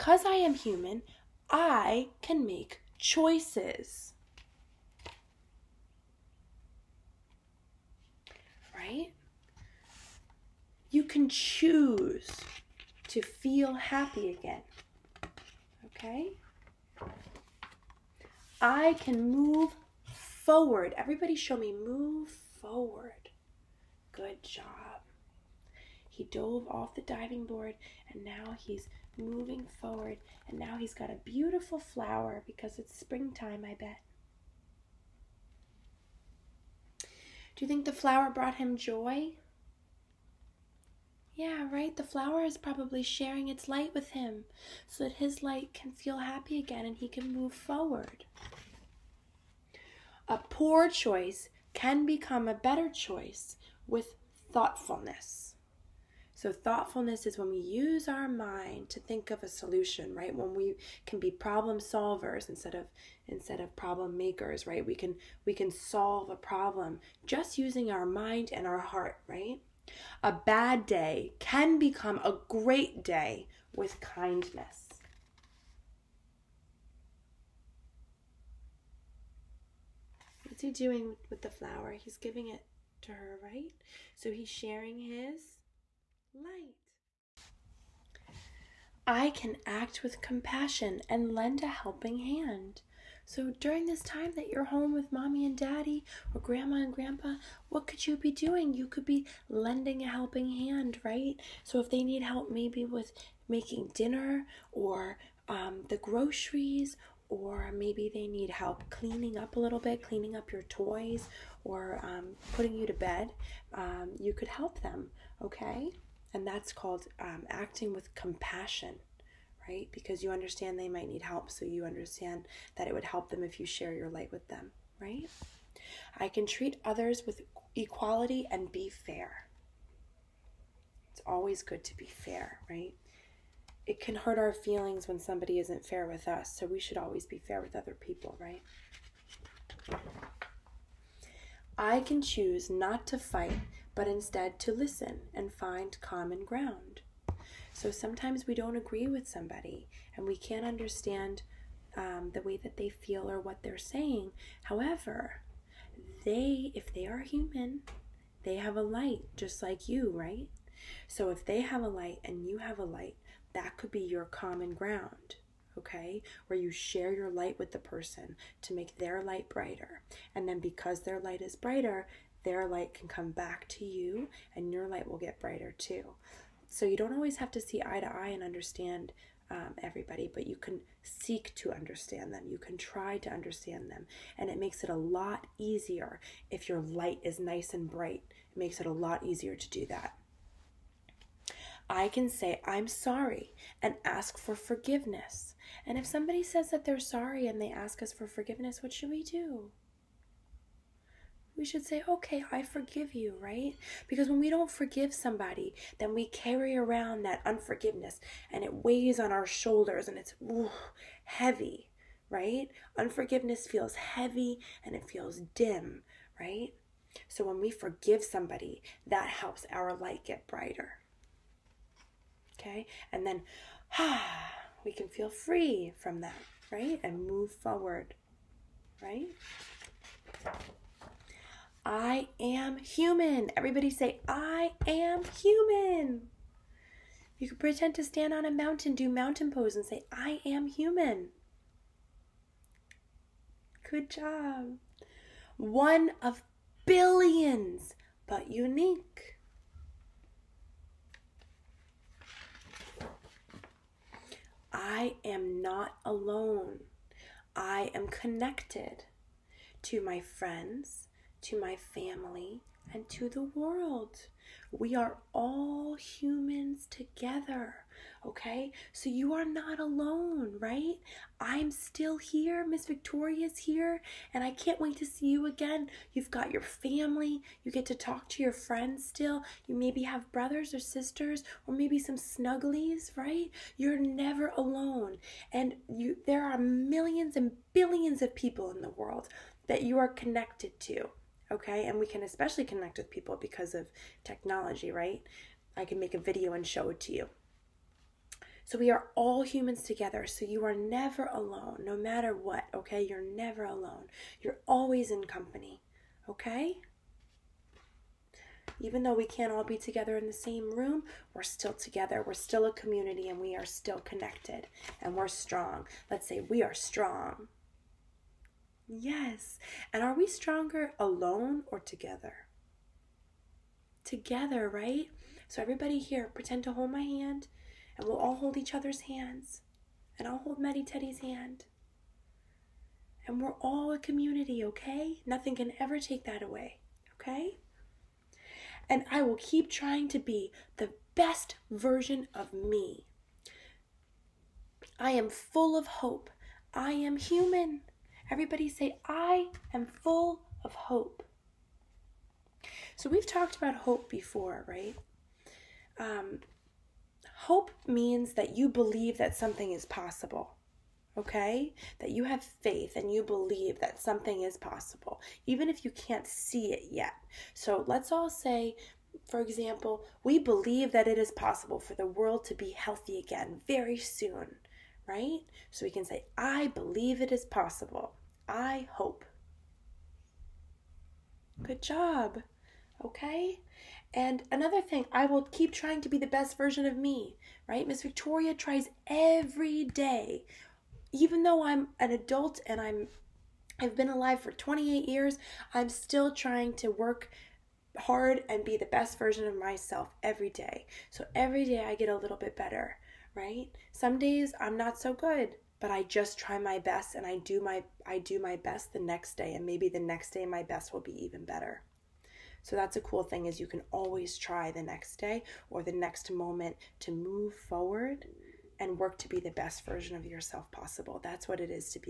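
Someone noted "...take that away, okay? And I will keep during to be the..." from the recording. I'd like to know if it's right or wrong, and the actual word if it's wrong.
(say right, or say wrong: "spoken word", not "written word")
wrong: "trying", not "during".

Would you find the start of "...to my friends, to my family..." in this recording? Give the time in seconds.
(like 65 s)
259 s.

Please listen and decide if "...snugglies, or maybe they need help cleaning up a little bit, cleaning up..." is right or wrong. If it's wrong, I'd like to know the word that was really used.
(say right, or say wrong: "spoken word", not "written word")
wrong: "groceries", not "snugglies".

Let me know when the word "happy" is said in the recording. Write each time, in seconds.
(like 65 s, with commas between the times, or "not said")
13 s, 46 s.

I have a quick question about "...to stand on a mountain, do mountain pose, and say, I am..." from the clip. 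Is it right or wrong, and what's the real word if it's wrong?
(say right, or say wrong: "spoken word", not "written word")
right.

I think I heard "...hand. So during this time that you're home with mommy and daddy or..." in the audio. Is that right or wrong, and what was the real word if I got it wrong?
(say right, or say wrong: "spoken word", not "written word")
right.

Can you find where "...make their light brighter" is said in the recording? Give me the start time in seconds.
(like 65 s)
168 s.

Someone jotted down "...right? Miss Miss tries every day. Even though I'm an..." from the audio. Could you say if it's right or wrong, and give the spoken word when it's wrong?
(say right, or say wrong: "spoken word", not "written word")
wrong: "Victoria", not "Miss".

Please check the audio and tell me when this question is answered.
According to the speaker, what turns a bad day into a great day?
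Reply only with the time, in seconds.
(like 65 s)
73 s.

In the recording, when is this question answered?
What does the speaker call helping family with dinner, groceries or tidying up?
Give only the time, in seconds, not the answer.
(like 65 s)
117 s.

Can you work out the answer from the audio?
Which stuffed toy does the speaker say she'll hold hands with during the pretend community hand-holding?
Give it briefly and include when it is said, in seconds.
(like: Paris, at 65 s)
Meddy Teddy, at 330 s.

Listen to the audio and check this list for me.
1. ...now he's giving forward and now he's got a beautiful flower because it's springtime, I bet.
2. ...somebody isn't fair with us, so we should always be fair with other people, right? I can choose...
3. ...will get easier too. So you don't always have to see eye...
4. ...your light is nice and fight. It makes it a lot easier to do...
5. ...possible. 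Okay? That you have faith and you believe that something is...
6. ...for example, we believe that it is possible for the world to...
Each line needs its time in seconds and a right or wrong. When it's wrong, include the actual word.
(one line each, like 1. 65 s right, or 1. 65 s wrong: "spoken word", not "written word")
1. 28 s wrong: "moving", not "giving"
2. 135 s right
3. 175 s wrong: "brighter", not "easier"
4. 186 s wrong: "bright", not "fight"
5. 359 s right
6. 369 s right.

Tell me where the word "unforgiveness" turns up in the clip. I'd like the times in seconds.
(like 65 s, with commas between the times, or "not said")
207 s, 212 s.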